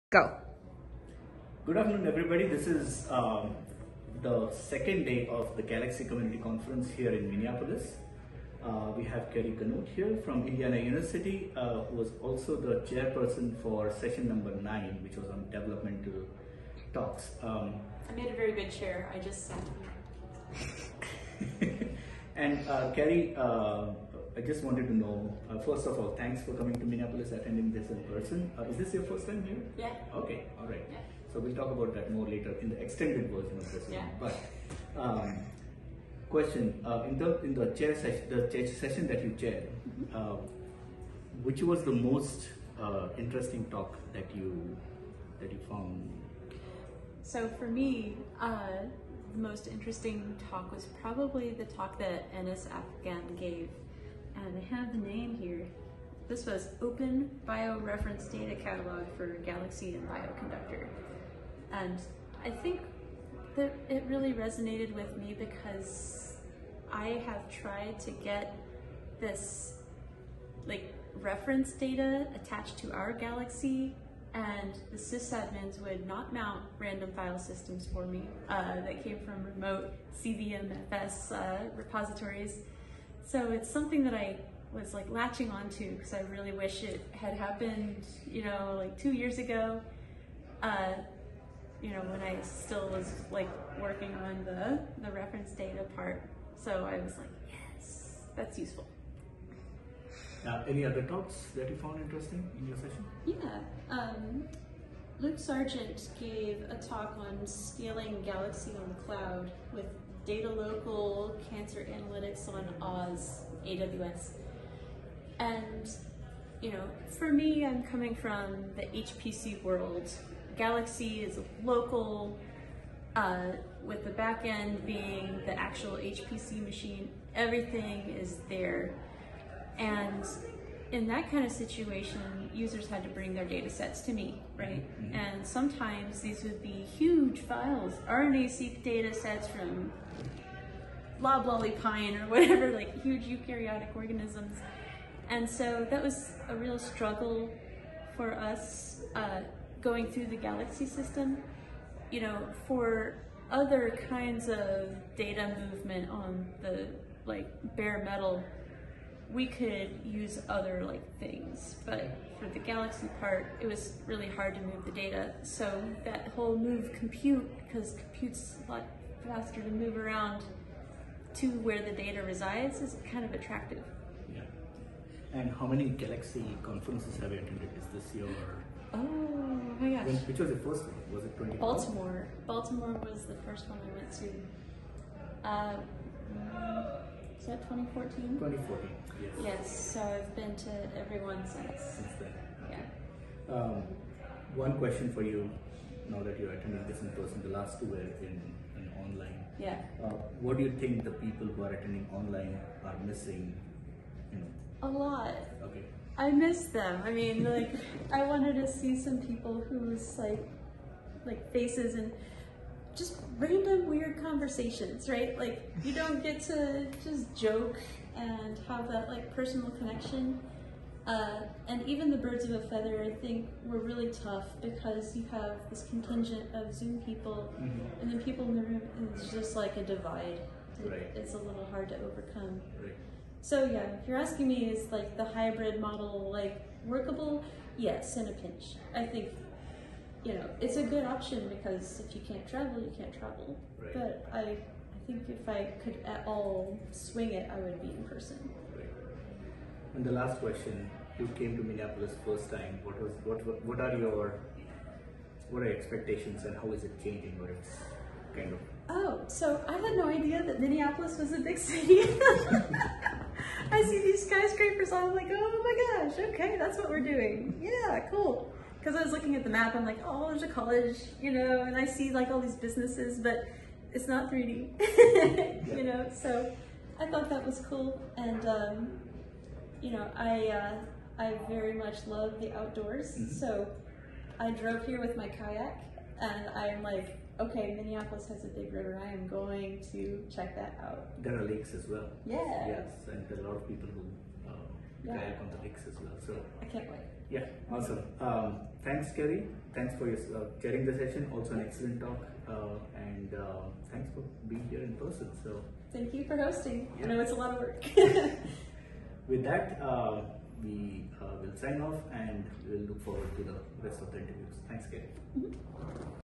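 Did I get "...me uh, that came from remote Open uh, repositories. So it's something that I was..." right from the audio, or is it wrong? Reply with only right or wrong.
wrong.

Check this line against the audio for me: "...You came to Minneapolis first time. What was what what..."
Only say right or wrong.
right.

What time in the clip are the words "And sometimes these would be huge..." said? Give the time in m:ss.
2:15.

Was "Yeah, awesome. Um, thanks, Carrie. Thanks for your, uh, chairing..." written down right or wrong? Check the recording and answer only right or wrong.
right.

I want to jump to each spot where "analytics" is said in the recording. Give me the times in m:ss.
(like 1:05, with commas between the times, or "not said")
1:51.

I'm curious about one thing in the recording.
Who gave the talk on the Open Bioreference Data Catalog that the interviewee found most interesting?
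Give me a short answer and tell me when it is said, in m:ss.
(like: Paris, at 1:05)
Enis Afgan, at 0:52.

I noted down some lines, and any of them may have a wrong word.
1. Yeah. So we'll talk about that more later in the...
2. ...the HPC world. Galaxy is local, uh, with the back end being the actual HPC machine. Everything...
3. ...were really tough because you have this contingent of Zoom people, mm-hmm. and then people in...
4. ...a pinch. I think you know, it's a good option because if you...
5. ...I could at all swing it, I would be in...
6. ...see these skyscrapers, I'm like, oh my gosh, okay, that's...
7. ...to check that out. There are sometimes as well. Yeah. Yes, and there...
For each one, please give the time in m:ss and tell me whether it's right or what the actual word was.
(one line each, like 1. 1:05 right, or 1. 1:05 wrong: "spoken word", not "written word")
1. 0:30 right
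2. 1:58 right
3. 3:43 right
4. 3:58 right
5. 4:05 right
6. 4:23 right
7. 4:49 wrong: "lakes", not "sometimes".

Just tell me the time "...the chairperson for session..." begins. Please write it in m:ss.
0:12.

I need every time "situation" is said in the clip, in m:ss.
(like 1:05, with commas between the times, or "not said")
2:11.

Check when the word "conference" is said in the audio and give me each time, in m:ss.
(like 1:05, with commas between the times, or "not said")
0:06, 2:56.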